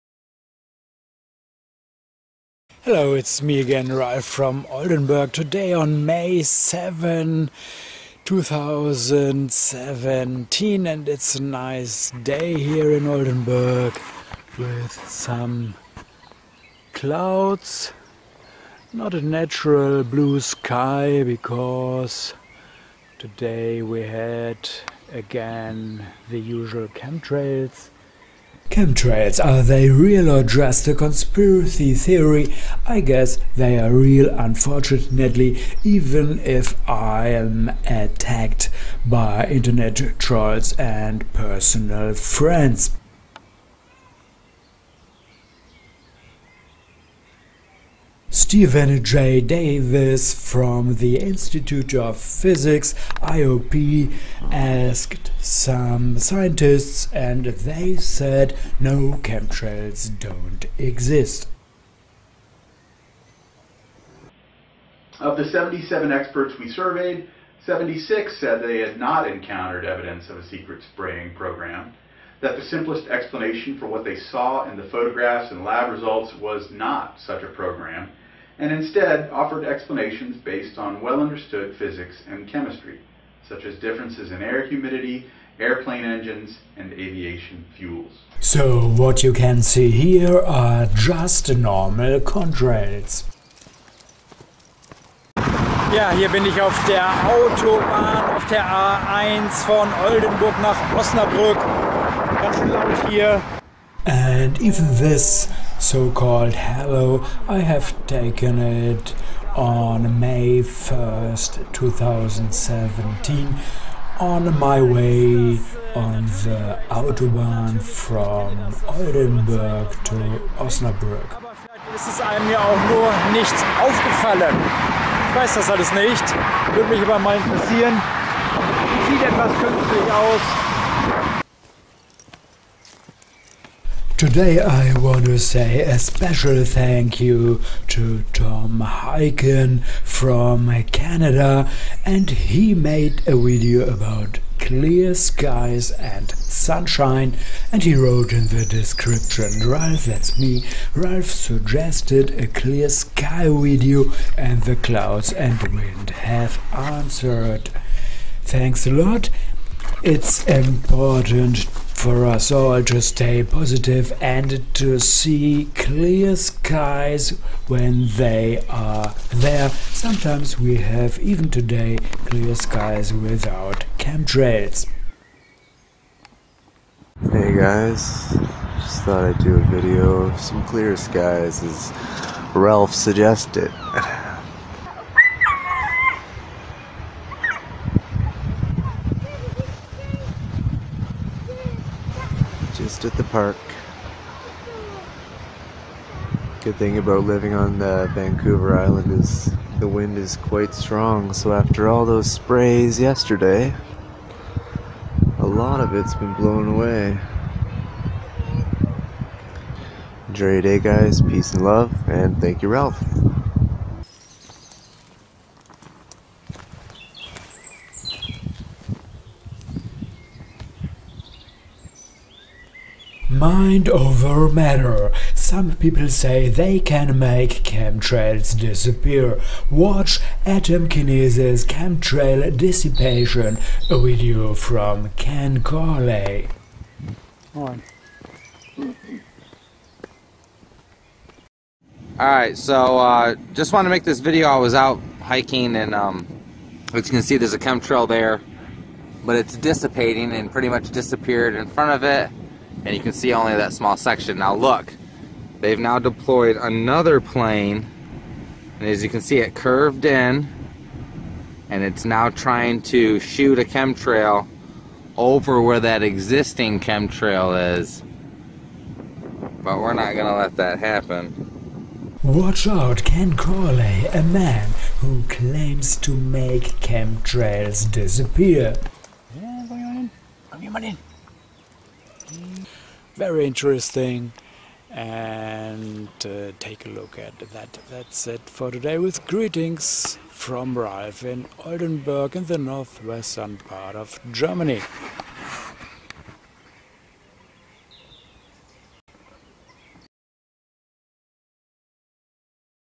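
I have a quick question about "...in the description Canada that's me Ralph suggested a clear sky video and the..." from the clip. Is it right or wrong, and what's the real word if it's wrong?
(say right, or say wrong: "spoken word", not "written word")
wrong: "Ralph", not "Canada".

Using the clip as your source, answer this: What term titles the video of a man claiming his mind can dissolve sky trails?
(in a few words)
Atomkinesis.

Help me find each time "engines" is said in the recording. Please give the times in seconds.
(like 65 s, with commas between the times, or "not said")
86 s.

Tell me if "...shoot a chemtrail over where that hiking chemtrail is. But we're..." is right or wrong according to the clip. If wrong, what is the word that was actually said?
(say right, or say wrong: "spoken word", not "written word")
wrong: "existing", not "hiking".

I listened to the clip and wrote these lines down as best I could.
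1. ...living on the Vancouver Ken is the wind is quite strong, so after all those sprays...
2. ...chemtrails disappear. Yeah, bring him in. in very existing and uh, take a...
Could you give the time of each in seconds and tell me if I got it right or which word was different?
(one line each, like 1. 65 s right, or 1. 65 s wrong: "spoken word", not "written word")
1. 197 s wrong: "Island", not "Ken"
2. 276 s wrong: "interesting", not "existing".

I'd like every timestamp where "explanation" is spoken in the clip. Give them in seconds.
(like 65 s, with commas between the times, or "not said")
73 s, 79 s.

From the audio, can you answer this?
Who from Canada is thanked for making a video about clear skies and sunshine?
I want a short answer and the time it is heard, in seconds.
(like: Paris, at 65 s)
Tom Hyken, at 138 s.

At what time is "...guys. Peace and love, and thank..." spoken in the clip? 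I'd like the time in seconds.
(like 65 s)
210 s.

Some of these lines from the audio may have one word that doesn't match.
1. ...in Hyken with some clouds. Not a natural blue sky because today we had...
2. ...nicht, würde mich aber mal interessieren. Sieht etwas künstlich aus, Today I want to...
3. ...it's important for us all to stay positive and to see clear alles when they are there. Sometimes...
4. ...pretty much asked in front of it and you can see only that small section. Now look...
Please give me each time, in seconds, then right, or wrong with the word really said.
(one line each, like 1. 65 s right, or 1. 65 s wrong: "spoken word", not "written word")
1. 12 s wrong: "Oldenburg", not "Hyken"
2. 125 s right
3. 160 s wrong: "skies", not "alles"
4. 250 s wrong: "disappeared", not "asked".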